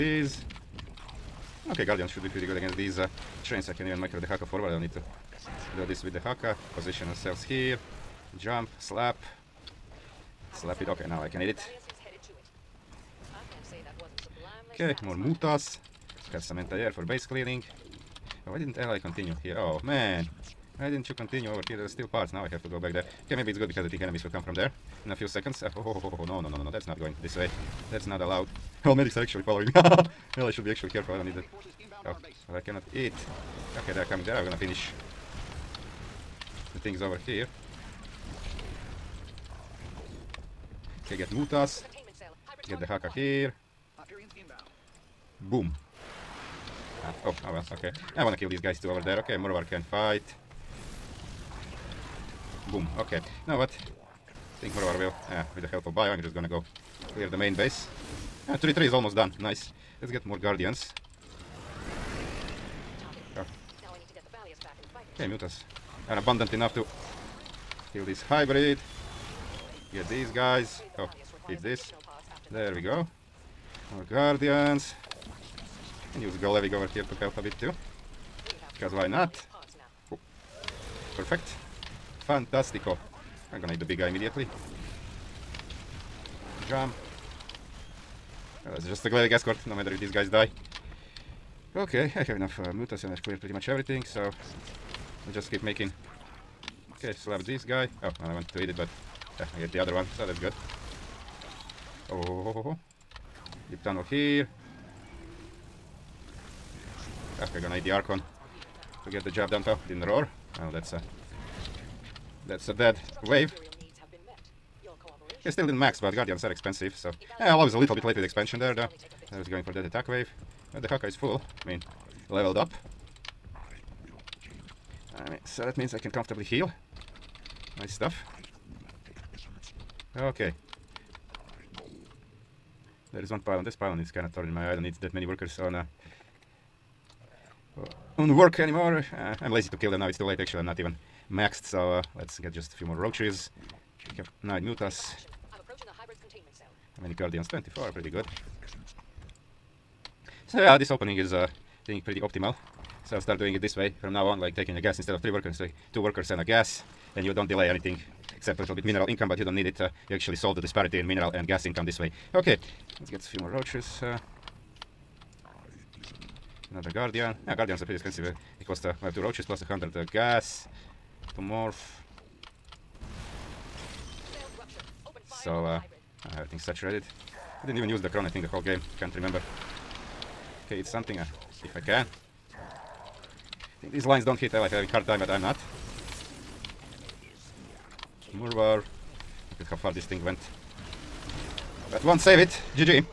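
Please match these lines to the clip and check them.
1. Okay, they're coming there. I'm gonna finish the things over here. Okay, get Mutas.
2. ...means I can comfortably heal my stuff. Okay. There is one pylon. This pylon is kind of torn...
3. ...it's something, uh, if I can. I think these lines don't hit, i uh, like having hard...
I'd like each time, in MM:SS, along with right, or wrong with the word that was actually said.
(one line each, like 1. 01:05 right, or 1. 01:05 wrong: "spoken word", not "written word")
1. 00:33 right
2. 02:05 right
3. 03:00 right.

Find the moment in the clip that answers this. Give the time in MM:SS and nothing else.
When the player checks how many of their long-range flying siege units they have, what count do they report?
02:27.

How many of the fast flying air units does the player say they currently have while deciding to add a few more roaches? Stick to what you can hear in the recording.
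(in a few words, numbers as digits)
9.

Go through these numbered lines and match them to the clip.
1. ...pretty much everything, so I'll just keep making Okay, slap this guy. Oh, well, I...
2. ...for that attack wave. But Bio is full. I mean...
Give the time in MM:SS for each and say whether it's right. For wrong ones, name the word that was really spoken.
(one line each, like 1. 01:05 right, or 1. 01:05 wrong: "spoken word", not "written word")
1. 01:33 right
2. 01:59 wrong: "Dehaka", not "Bio".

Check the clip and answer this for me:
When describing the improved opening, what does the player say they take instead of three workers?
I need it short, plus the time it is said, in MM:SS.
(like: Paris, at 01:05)
two workers and a gas, at 02:35.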